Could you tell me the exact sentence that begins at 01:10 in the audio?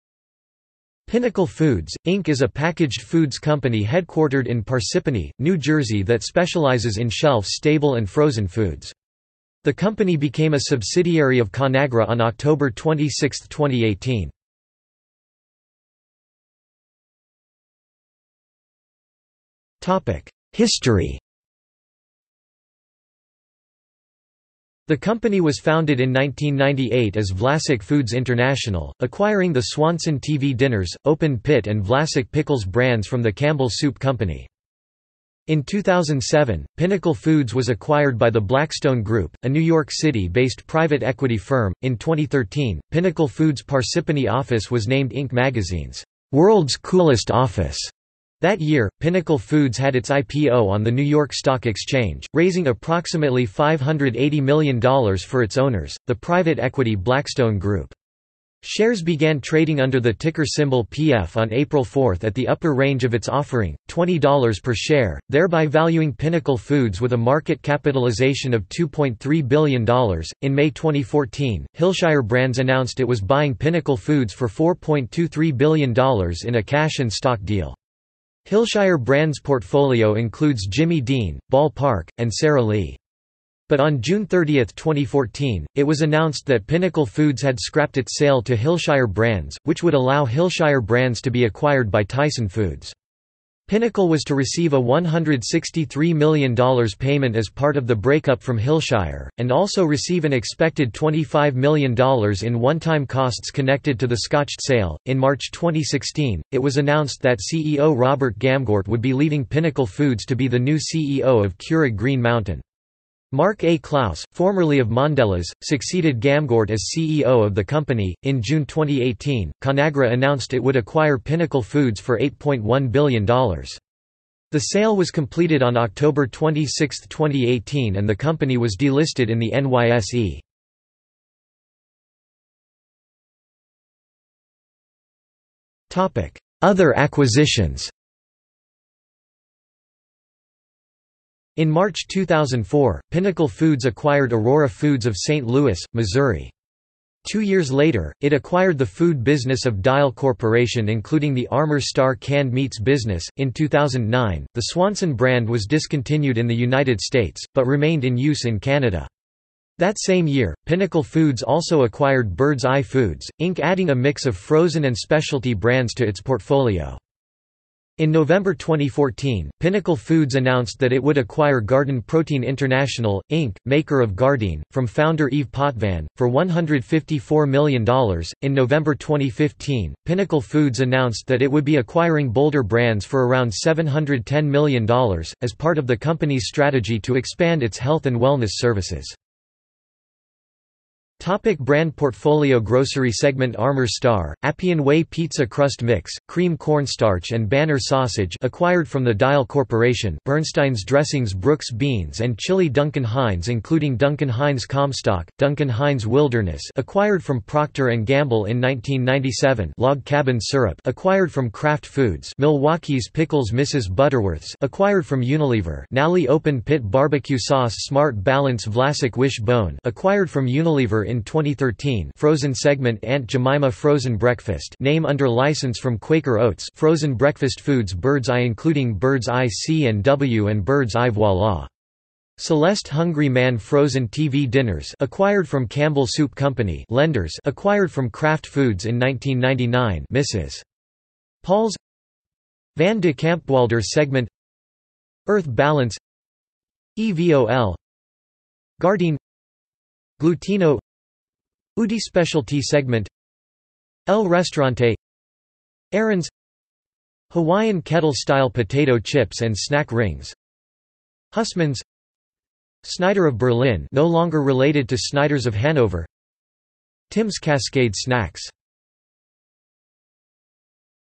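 In May 2014, Hillshire Brands announced it was buying Pinnacle Foods for $4.23 billion in a cash and stock deal.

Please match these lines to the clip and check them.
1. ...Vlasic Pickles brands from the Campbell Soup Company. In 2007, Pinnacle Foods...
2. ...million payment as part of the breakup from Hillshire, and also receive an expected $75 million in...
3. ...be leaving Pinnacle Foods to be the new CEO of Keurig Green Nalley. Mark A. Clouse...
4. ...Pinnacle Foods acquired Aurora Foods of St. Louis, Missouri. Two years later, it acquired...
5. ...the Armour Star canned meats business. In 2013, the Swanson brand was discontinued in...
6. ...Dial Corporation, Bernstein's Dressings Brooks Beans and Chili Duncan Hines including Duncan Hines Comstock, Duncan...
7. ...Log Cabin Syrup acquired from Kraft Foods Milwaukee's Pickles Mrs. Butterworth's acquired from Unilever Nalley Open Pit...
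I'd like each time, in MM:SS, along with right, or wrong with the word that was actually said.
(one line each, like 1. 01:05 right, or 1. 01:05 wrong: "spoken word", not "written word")
1. 00:31 right
2. 01:36 wrong: "25", not "75"
3. 01:49 wrong: "Mountain", not "Nalley"
4. 02:23 right
5. 02:31 wrong: "2009", not "2013"
6. 03:19 right
7. 03:29 right.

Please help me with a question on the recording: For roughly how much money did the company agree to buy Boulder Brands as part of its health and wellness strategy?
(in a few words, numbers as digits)
$710 million.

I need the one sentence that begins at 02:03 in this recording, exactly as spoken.
The sale was completed on October 26, 2018, and the company was delisted in the NYSE.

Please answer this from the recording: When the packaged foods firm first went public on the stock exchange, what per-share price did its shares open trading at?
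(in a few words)
$20.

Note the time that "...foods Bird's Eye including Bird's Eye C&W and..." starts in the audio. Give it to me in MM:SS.
03:47.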